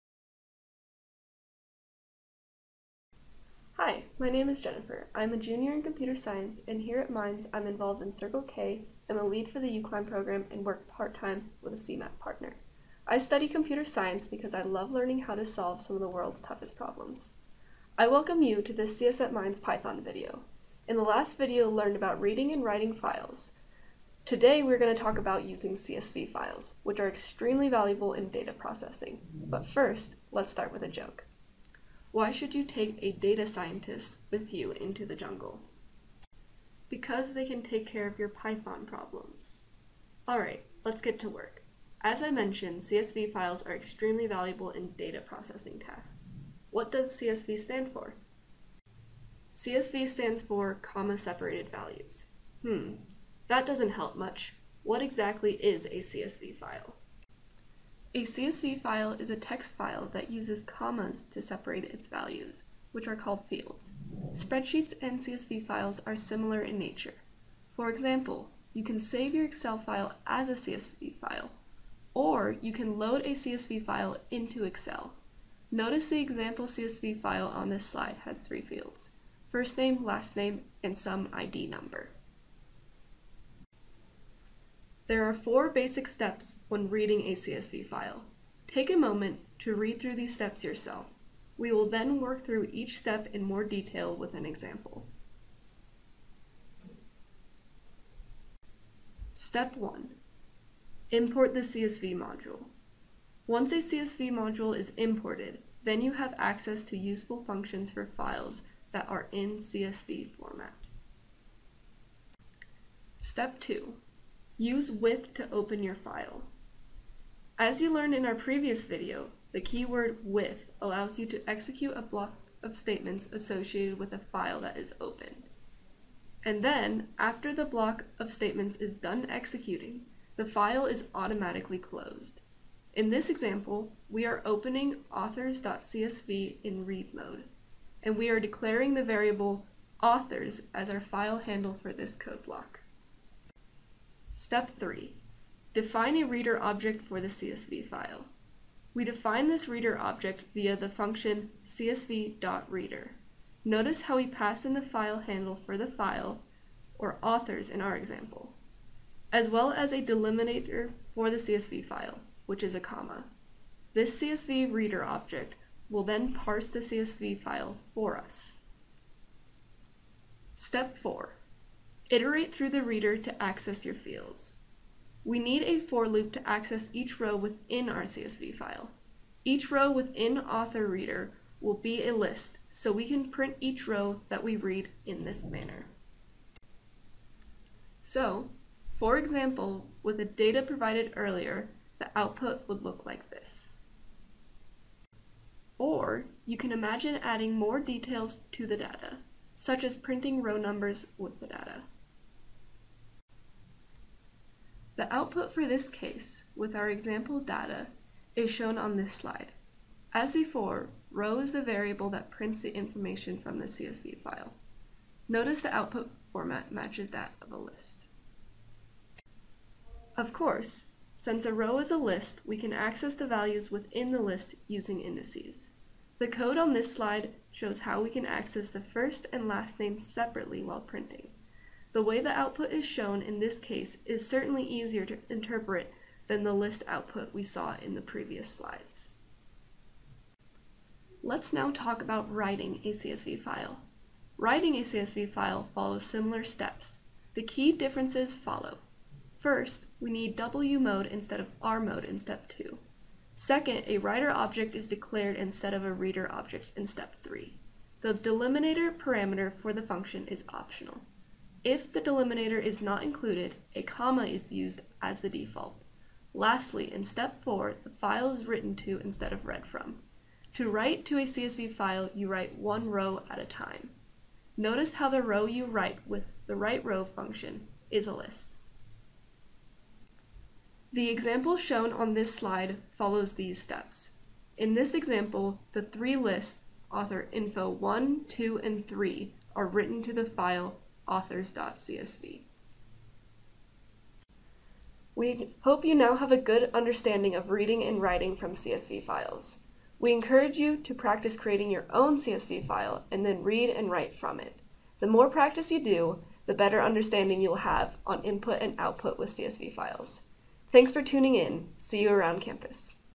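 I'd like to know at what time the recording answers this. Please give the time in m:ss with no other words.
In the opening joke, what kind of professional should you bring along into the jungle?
0:33.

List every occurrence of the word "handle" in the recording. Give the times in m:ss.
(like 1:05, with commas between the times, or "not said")
2:21, 2:35.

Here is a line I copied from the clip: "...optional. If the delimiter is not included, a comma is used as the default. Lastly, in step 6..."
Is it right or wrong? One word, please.
wrong.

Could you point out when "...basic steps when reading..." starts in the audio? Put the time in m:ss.
1:25.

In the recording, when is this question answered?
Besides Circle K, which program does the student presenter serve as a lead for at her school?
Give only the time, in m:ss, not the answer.
0:09.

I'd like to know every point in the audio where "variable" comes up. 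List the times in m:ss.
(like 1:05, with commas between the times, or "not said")
2:19, 3:31.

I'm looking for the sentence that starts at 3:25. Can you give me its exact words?
The output for this case, with our example data, is shown on this slide.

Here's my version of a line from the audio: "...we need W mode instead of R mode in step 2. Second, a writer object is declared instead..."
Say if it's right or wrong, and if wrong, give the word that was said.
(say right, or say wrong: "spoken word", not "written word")
right.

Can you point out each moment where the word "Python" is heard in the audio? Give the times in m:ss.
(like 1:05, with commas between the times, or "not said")
0:19, 0:38.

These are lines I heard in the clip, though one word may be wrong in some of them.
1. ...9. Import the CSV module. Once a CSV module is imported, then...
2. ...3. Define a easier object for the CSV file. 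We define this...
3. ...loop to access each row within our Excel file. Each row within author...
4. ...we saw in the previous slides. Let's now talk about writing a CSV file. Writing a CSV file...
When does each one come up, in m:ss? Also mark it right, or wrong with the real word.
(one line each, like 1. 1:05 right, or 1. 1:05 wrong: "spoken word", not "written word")
1. 1:39 wrong: "1", not "9"
2. 2:24 wrong: "reader", not "easier"
3. 2:56 wrong: "CSV", not "Excel"
4. 3:57 right.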